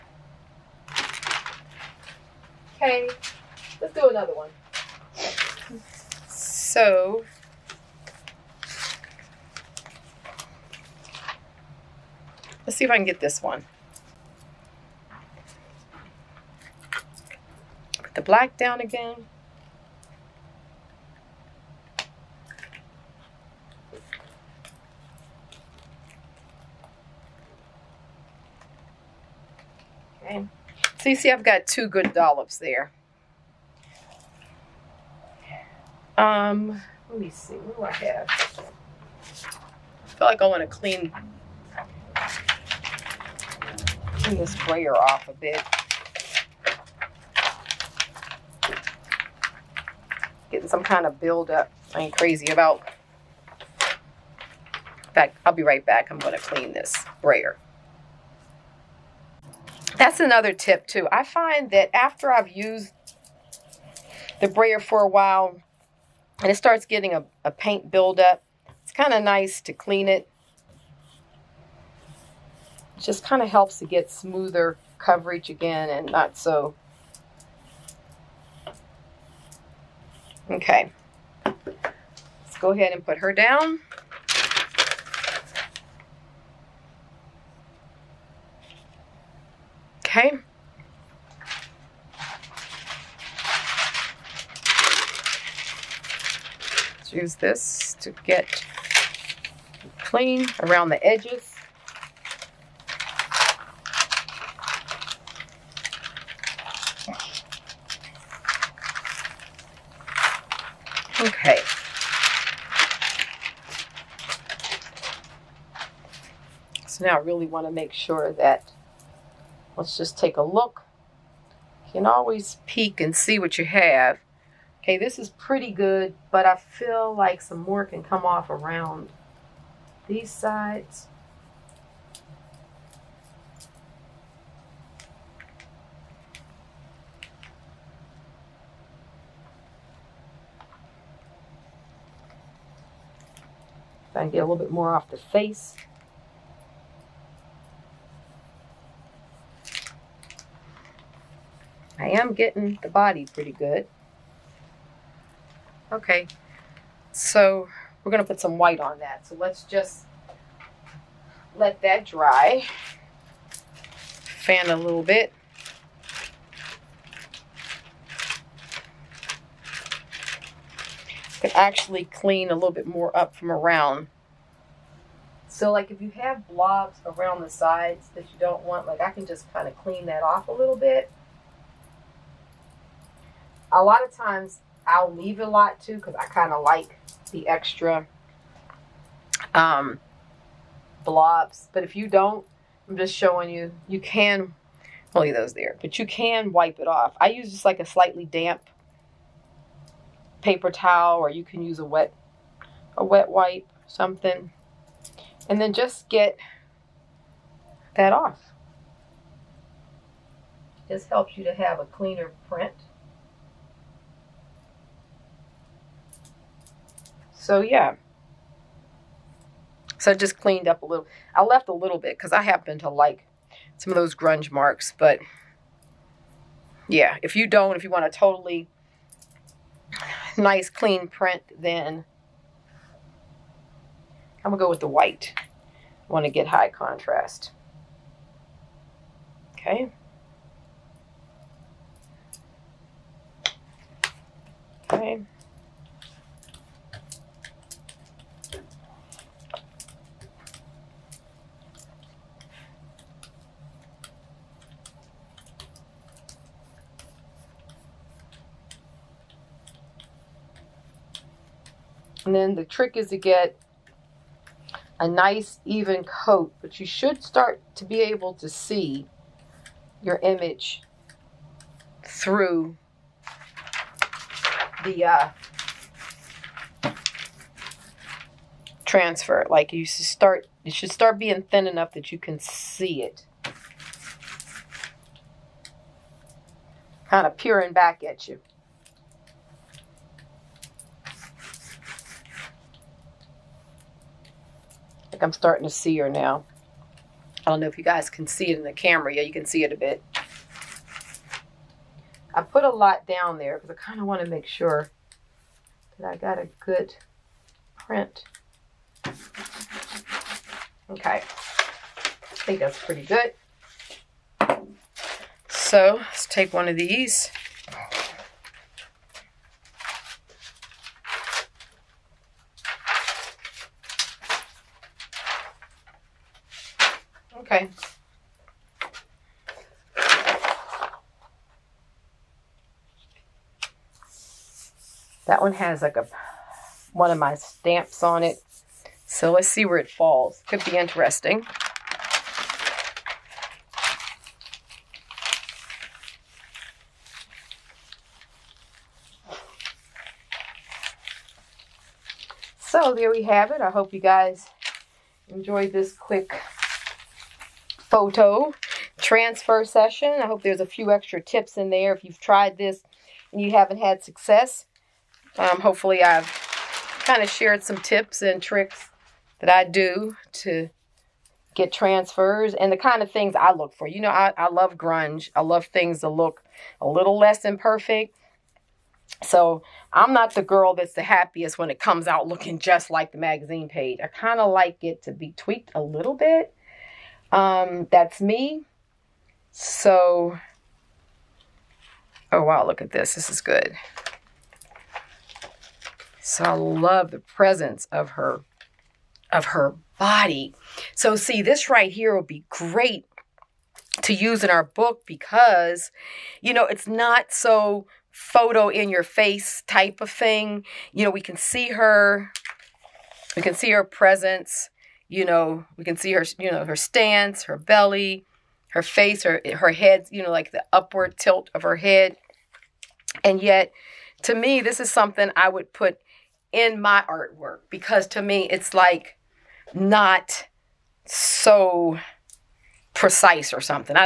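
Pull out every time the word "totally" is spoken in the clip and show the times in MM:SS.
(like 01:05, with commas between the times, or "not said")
03:48.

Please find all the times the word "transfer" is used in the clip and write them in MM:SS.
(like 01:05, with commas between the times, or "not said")
04:38, 05:58, 06:11.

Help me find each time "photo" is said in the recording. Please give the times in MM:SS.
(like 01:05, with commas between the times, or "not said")
05:57, 06:48.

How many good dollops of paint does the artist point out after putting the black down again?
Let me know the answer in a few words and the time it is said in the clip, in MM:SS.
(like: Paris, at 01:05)
2, at 00:31.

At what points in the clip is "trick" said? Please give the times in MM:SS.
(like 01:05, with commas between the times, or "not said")
04:22, 06:08.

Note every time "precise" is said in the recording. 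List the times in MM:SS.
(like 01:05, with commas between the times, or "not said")
07:12.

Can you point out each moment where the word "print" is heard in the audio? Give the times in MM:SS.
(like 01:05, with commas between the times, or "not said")
03:32, 03:51, 05:07.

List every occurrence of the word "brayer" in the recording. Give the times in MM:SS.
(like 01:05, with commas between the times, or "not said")
00:44, 00:57, 01:04.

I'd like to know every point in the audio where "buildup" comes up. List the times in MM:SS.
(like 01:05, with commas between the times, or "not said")
00:51, 01:07.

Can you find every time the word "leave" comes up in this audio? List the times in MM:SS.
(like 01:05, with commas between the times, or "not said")
03:05, 03:15.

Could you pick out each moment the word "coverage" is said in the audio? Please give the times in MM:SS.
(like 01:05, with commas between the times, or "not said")
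01:14.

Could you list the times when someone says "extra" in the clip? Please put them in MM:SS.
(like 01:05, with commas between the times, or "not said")
03:07, 06:00.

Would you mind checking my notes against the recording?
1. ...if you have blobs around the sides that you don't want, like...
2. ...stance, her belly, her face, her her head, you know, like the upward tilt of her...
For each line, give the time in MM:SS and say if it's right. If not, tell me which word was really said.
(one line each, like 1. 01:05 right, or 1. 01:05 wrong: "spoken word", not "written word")
1. 02:55 right
2. 06:56 right.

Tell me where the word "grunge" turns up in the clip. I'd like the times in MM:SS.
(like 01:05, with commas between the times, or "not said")
03:44, 06:14.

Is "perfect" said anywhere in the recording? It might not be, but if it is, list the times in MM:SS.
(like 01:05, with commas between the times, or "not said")
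06:17.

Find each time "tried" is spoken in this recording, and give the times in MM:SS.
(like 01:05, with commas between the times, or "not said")
06:02.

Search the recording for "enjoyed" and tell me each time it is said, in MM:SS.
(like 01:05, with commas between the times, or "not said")
05:55.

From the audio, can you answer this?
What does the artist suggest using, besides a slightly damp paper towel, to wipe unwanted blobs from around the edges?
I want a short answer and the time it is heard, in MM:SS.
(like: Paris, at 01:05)
A wet wipe, at 03:22.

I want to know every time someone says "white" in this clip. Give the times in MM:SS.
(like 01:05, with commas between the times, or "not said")
02:38, 03:54.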